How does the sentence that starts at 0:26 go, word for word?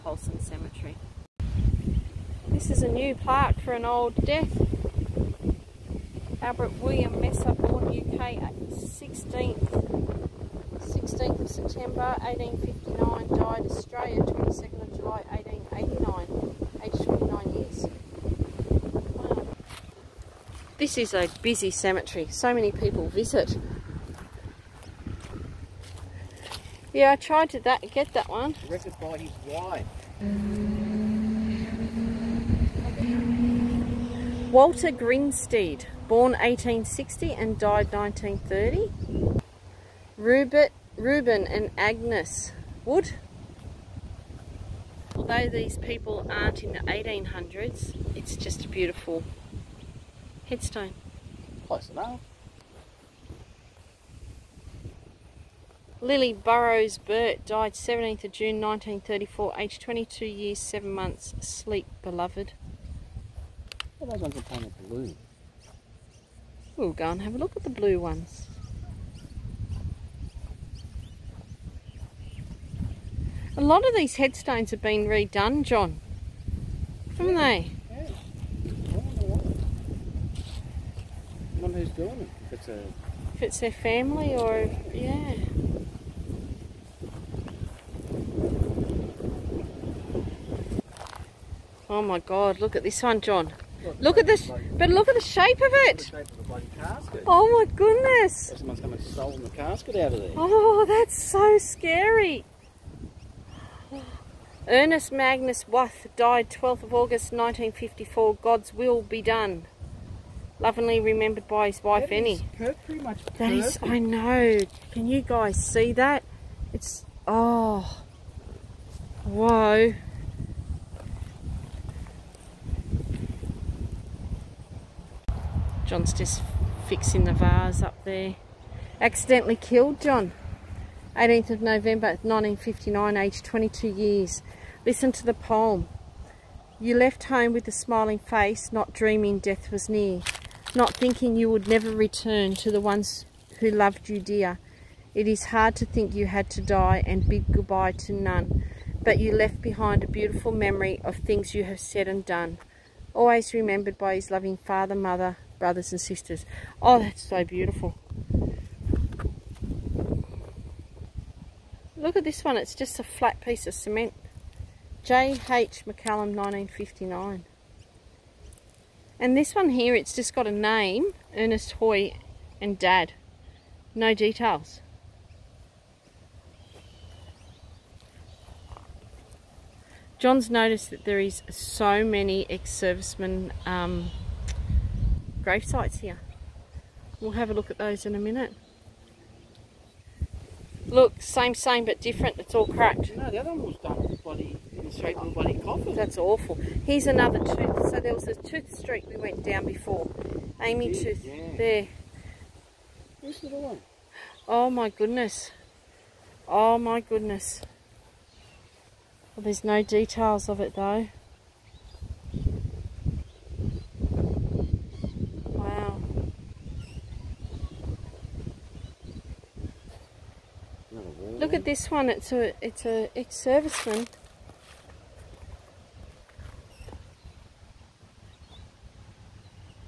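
Yeah, I tried to that get that one.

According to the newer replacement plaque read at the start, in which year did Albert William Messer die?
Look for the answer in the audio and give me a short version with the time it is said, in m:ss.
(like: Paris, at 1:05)
1889, at 0:15.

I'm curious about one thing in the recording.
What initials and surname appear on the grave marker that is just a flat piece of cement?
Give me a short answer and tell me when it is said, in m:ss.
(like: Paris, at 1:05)
J.H. McCallum, at 2:45.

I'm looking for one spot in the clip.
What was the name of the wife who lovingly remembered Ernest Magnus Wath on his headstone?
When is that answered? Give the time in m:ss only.
1:52.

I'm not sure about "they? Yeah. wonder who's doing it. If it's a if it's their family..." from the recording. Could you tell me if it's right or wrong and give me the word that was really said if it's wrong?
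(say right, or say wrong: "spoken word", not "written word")
right.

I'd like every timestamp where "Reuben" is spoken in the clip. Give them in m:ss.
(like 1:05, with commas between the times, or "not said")
0:40.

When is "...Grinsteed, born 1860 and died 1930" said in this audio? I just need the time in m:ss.
0:34.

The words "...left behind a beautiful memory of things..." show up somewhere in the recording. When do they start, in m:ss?
2:29.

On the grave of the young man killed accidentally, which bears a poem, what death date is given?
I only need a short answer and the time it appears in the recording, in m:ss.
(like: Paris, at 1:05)
18 November 1959, at 2:11.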